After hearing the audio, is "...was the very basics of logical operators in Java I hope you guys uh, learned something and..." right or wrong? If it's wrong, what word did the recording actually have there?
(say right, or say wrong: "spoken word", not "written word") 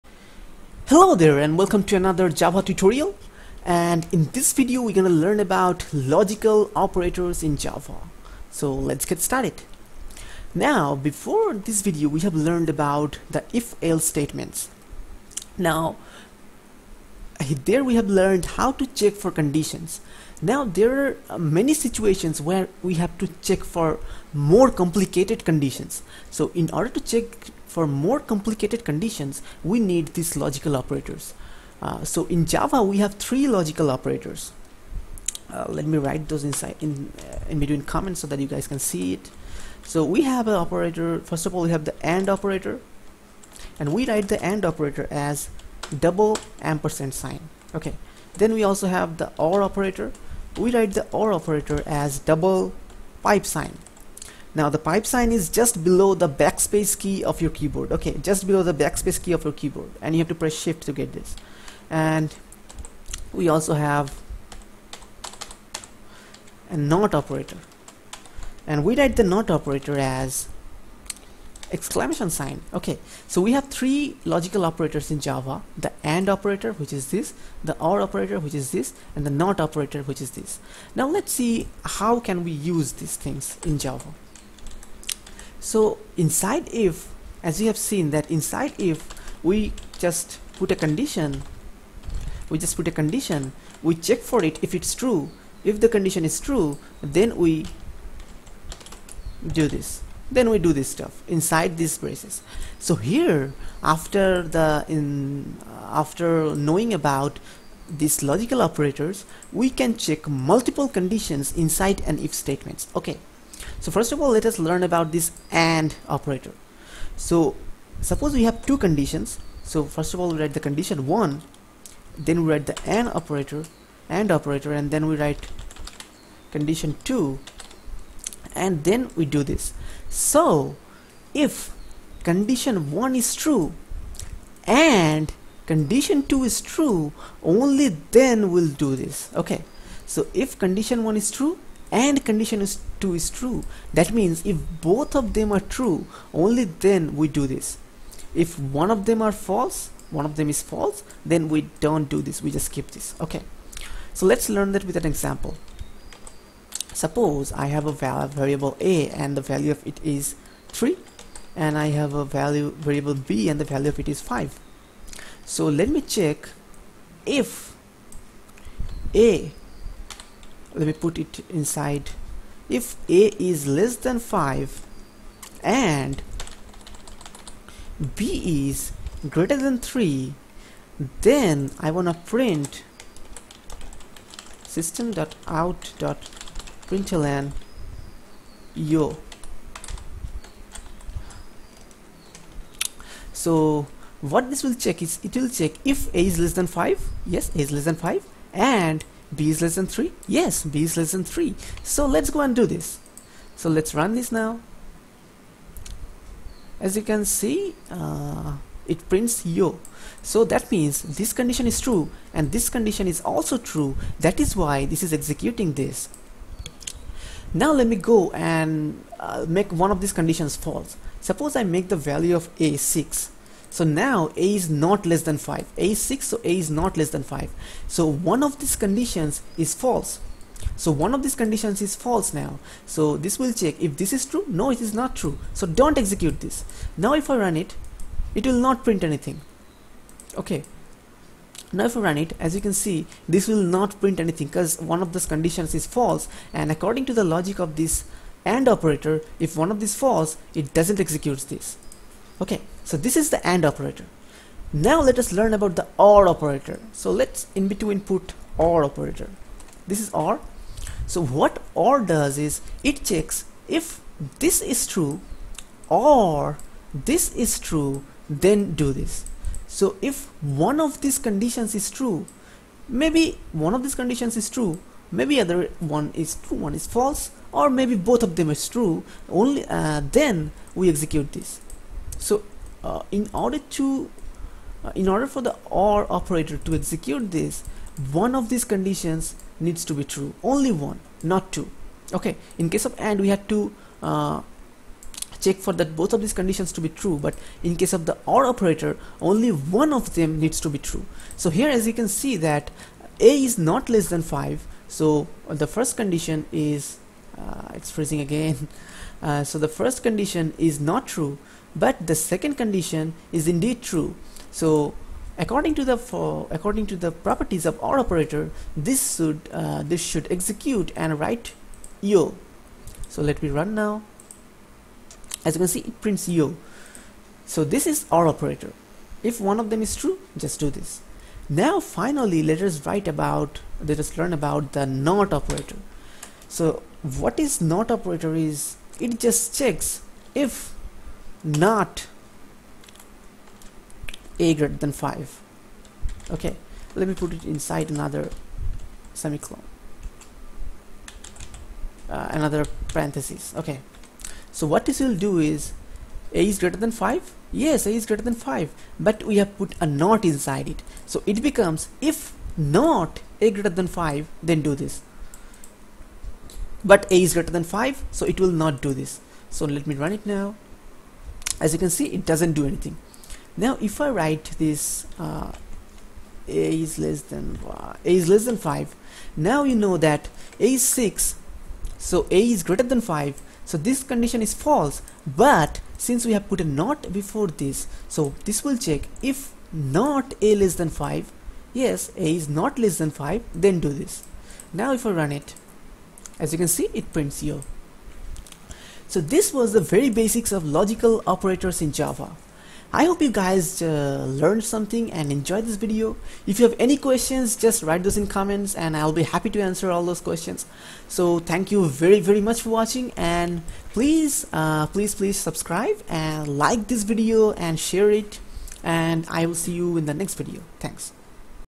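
right.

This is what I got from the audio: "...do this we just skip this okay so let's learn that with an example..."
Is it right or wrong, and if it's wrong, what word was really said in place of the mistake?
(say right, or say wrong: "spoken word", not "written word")
right.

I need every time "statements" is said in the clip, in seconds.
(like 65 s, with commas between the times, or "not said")
14 s, 112 s.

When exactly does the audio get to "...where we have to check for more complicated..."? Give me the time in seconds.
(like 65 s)
22 s.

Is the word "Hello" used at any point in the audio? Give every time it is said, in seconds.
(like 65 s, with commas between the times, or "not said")
0 s.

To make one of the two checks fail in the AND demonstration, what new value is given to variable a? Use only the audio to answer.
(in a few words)
6.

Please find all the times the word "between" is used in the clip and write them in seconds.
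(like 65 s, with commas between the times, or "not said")
37 s, 257 s.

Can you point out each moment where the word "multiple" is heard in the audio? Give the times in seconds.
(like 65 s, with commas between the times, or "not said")
110 s.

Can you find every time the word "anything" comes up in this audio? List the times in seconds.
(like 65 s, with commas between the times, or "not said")
239 s, 244 s, 372 s.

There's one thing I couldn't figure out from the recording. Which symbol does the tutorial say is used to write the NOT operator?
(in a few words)
Exclamation sign.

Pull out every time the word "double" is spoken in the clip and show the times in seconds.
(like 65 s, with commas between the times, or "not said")
45 s, 52 s.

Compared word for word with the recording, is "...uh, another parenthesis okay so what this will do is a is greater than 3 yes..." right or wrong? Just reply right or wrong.
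wrong.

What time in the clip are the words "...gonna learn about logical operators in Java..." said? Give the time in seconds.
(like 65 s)
4 s.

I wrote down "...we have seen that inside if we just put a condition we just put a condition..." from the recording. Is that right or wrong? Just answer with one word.
right.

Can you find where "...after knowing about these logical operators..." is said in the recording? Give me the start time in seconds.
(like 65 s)
106 s.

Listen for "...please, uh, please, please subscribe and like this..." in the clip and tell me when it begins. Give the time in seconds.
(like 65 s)
413 s.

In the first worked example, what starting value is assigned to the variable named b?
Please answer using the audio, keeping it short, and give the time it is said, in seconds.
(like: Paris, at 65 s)
5, at 163 s.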